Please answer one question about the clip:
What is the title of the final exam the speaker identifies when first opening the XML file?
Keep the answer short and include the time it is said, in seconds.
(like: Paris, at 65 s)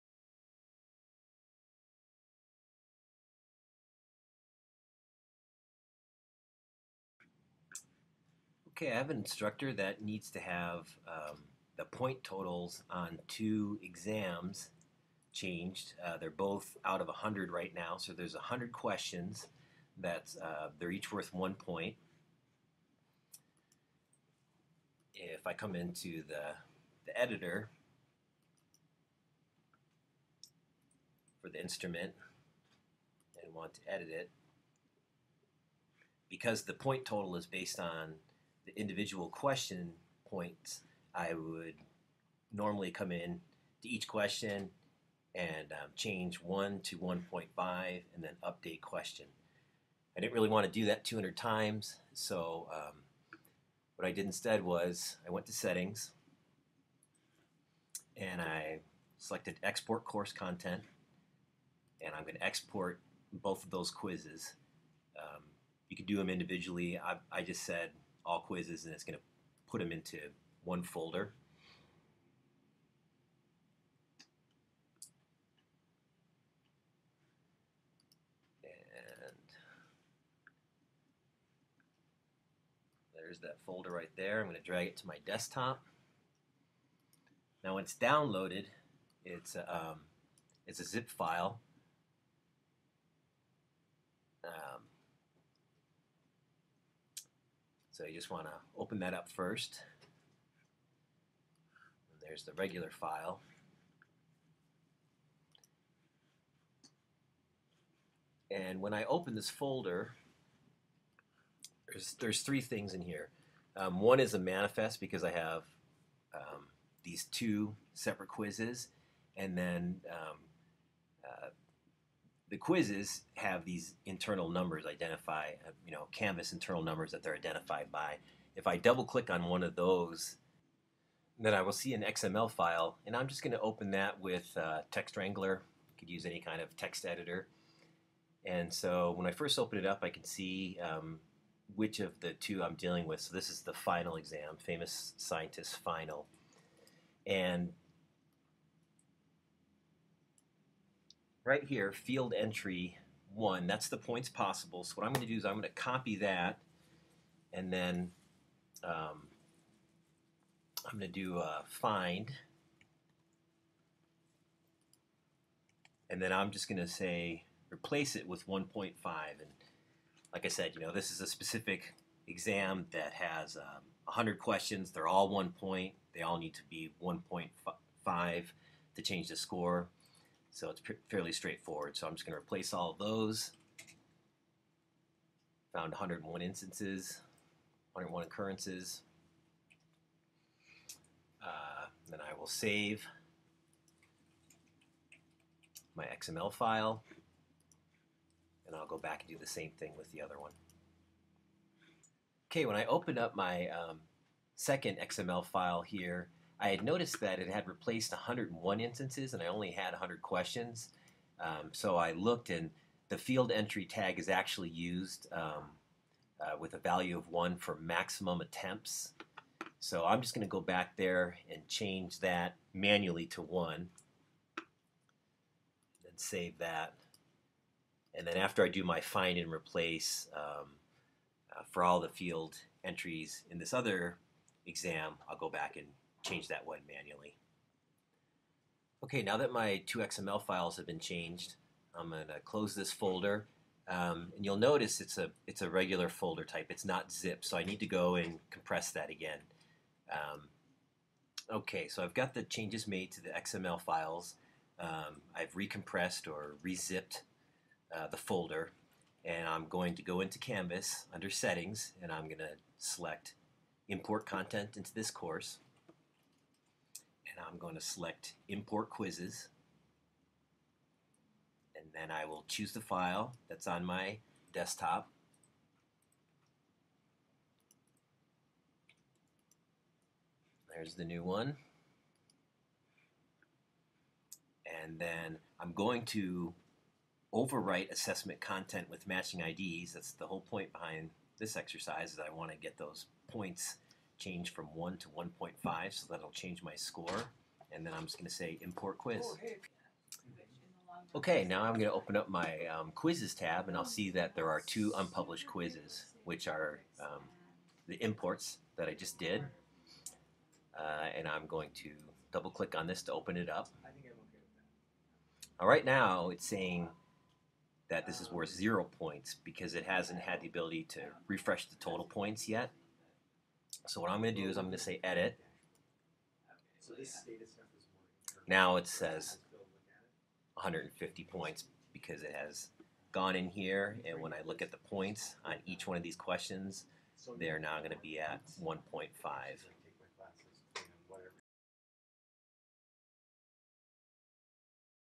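famous scientist final, at 144 s.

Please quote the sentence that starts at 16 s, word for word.
Uh, they're both out of 100 right now, so there's 100 questions.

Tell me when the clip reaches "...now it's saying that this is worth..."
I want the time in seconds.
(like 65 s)
315 s.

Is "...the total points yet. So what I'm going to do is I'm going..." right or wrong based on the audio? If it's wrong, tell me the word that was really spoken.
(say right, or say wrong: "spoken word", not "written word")
right.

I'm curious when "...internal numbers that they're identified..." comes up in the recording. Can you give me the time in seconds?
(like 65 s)
126 s.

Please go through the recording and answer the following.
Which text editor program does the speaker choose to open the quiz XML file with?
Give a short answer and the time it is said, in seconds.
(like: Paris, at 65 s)
Text Wrangler, at 134 s.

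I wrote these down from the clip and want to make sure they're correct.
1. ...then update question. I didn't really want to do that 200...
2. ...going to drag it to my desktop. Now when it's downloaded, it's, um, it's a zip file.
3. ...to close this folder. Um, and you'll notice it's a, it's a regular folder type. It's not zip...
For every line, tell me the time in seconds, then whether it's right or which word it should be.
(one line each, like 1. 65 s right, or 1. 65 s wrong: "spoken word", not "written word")
1. 48 s right
2. 84 s right
3. 242 s right.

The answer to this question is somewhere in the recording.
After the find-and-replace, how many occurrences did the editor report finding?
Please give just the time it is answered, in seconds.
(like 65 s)
187 s.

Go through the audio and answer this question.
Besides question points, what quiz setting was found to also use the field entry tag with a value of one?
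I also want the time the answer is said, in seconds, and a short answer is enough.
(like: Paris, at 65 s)
maximum attempts, at 217 s.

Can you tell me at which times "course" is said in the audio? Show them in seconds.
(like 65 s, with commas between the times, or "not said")
60 s, 265 s.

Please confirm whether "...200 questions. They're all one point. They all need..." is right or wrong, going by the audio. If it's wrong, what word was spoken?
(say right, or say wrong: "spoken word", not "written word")
wrong: "100", not "200".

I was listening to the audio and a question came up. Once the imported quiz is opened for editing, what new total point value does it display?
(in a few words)
150 points.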